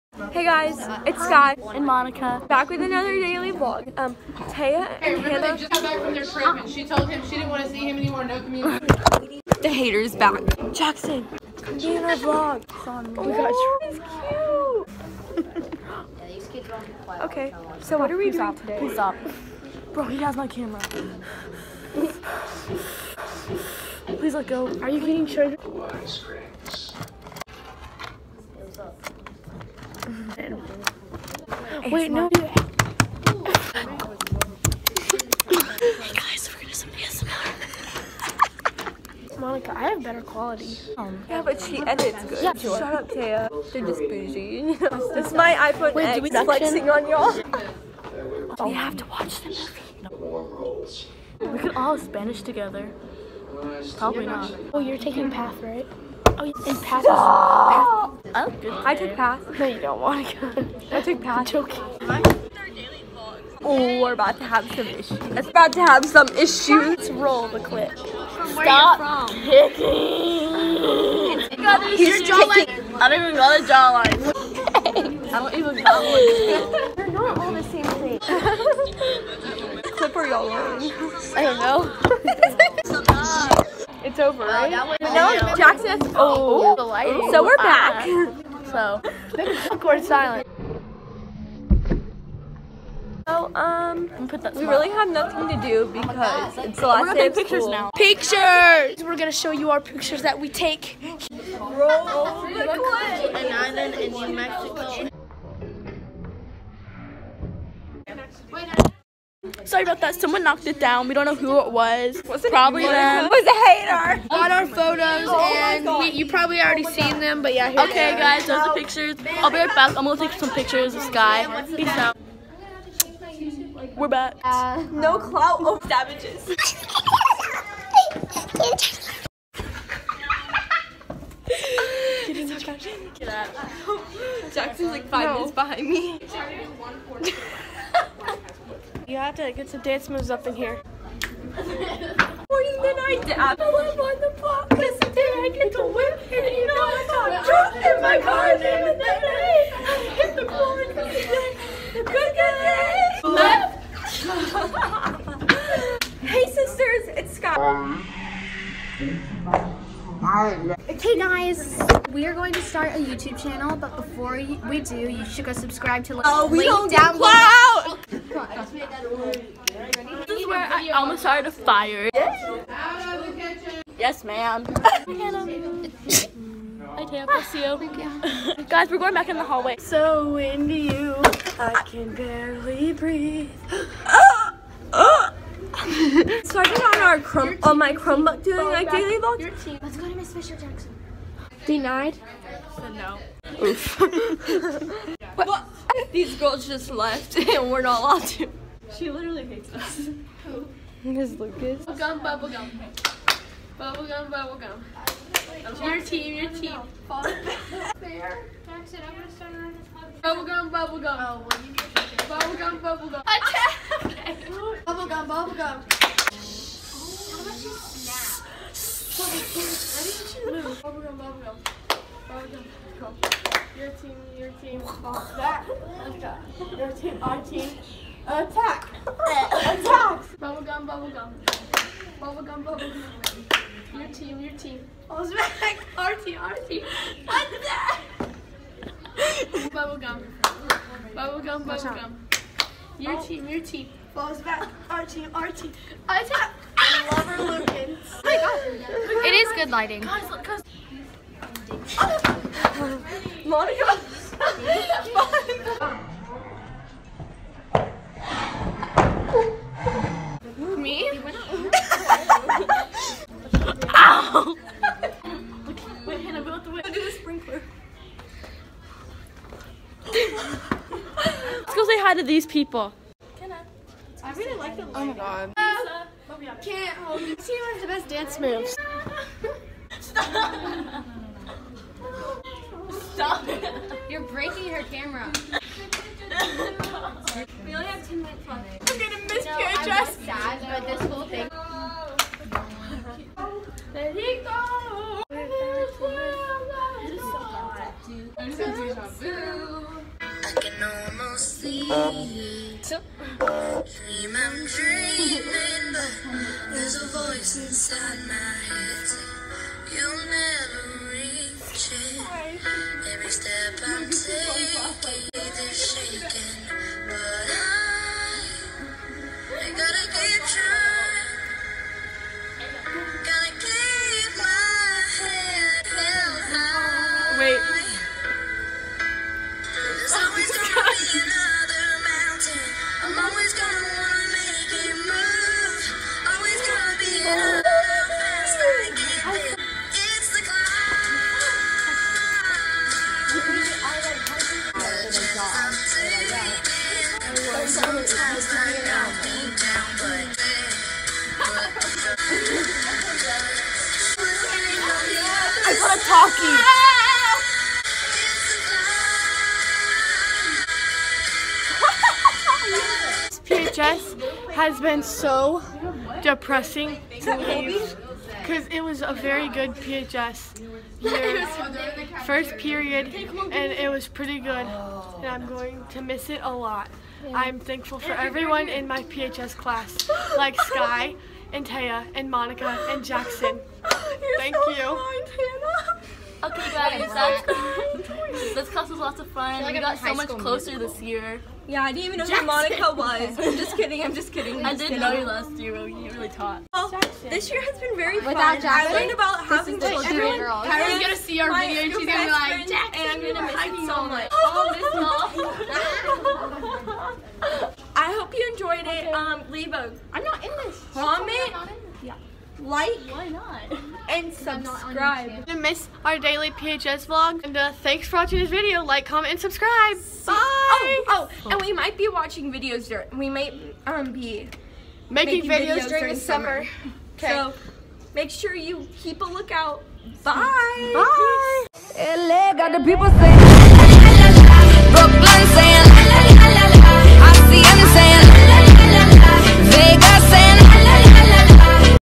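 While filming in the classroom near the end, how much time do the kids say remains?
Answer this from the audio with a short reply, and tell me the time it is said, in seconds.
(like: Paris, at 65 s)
10 minutes, at 288 s.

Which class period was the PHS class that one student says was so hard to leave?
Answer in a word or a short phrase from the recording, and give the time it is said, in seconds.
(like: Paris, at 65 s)
First period, at 372 s.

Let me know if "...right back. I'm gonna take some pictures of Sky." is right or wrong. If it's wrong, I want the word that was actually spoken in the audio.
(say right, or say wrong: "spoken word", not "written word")
right.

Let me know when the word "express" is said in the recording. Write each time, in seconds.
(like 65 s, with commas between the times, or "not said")
not said.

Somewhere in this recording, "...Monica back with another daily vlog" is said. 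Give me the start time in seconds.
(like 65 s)
1 s.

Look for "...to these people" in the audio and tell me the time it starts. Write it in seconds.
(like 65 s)
272 s.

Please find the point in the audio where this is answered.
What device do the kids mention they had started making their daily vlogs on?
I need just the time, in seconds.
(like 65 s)
187 s.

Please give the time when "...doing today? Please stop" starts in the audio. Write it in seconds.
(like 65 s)
18 s.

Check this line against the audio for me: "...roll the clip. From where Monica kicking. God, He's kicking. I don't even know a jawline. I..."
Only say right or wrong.
wrong.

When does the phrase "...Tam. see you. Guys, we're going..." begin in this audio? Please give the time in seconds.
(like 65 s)
177 s.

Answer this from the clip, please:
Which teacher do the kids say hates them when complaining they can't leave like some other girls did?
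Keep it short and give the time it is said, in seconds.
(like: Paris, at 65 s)
Ms. Lucas, at 201 s.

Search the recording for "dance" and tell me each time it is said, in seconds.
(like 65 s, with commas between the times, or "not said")
139 s, 278 s.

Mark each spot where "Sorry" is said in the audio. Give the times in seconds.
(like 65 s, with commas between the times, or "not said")
109 s.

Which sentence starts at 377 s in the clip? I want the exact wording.
I'm thankful for everyone in my PHS class, like Sky and Taya and Monica and Jackson.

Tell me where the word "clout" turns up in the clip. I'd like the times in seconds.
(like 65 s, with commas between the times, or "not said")
125 s, 167 s.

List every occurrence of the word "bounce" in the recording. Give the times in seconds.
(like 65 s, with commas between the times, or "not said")
225 s, 235 s.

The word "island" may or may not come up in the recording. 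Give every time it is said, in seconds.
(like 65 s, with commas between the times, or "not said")
103 s.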